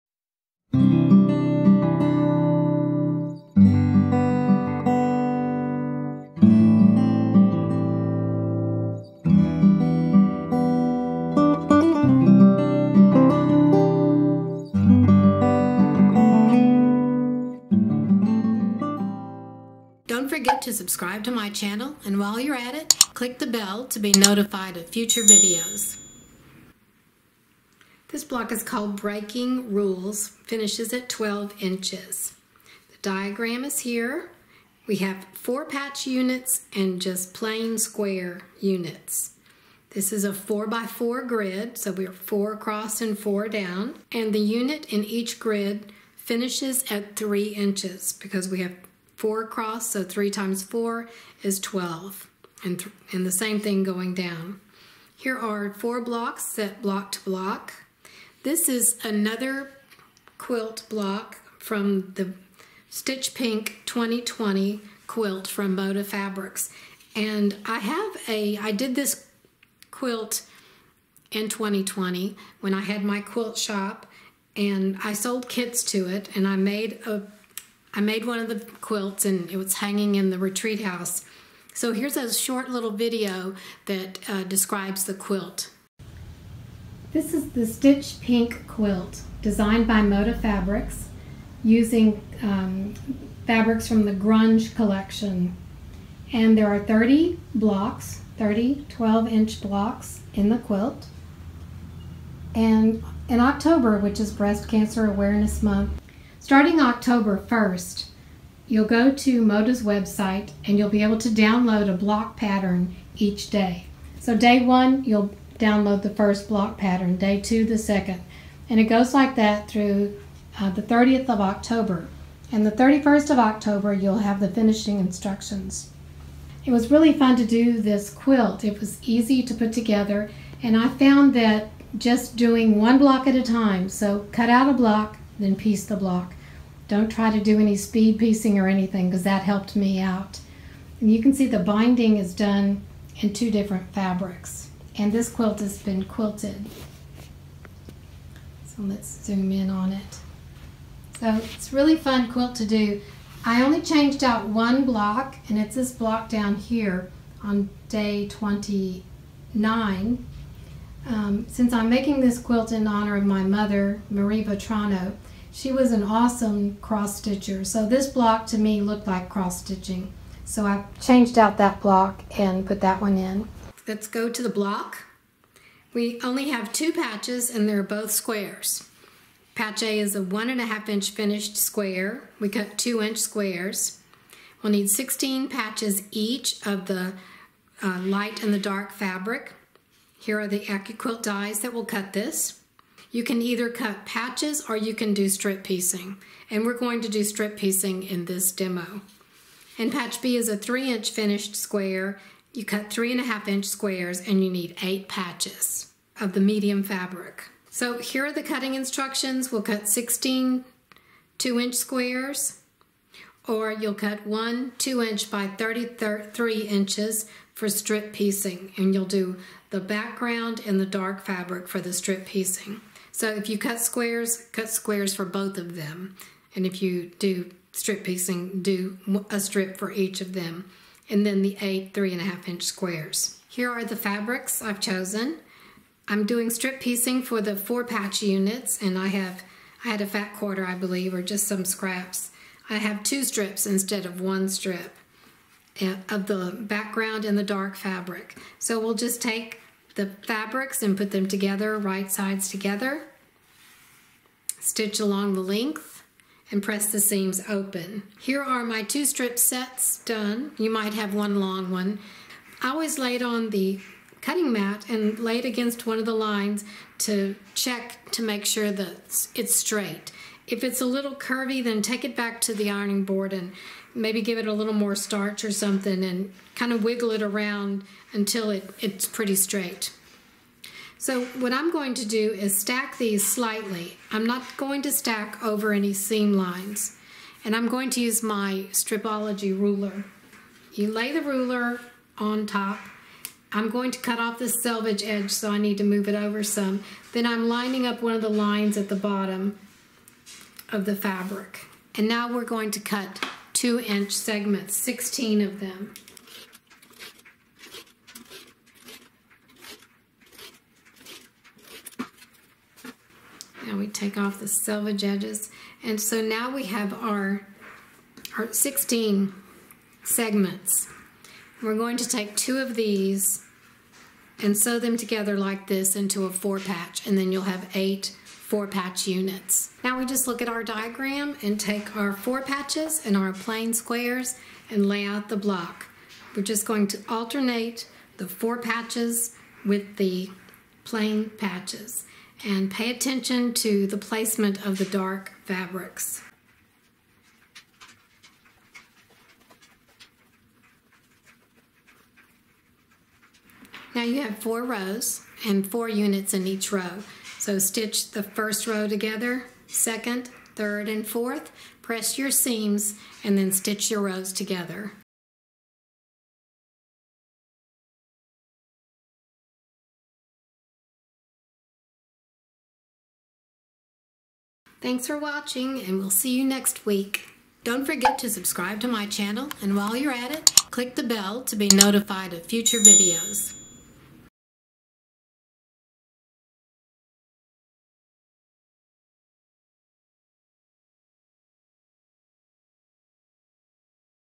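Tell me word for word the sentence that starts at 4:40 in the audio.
So what I'm going to do is stack these slightly.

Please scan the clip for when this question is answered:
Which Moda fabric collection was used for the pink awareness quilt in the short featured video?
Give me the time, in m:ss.
1:34.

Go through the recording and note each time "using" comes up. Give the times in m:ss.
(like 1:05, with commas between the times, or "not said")
1:31.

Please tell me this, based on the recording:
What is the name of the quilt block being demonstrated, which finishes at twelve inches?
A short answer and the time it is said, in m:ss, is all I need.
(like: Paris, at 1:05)
Breaking Rules, at 0:28.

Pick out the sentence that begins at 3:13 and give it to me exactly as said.
You can either cut patches or you can do strip piecing.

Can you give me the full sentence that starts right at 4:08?
So we'll just take the fabrics and put them together, right sides together.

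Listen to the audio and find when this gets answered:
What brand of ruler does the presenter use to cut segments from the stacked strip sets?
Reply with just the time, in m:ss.
4:48.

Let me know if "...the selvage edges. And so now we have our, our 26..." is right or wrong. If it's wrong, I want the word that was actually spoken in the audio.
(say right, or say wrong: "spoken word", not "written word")
wrong: "16", not "26".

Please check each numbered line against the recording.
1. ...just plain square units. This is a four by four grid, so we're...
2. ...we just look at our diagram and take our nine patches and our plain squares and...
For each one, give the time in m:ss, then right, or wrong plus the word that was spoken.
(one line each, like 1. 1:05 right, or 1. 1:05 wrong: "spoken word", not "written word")
1. 0:37 right
2. 5:29 wrong: "four", not "nine".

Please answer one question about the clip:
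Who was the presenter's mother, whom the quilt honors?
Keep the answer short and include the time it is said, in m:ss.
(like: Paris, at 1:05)
Marie Vetrano, at 2:44.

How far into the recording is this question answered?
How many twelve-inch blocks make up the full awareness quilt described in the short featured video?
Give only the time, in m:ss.
1:38.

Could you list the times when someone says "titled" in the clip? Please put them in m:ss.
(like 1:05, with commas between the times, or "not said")
not said.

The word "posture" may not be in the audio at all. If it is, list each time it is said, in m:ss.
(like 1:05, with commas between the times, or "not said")
not said.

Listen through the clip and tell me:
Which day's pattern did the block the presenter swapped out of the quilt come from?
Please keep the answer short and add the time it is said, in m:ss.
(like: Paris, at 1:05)
Day 29, at 2:37.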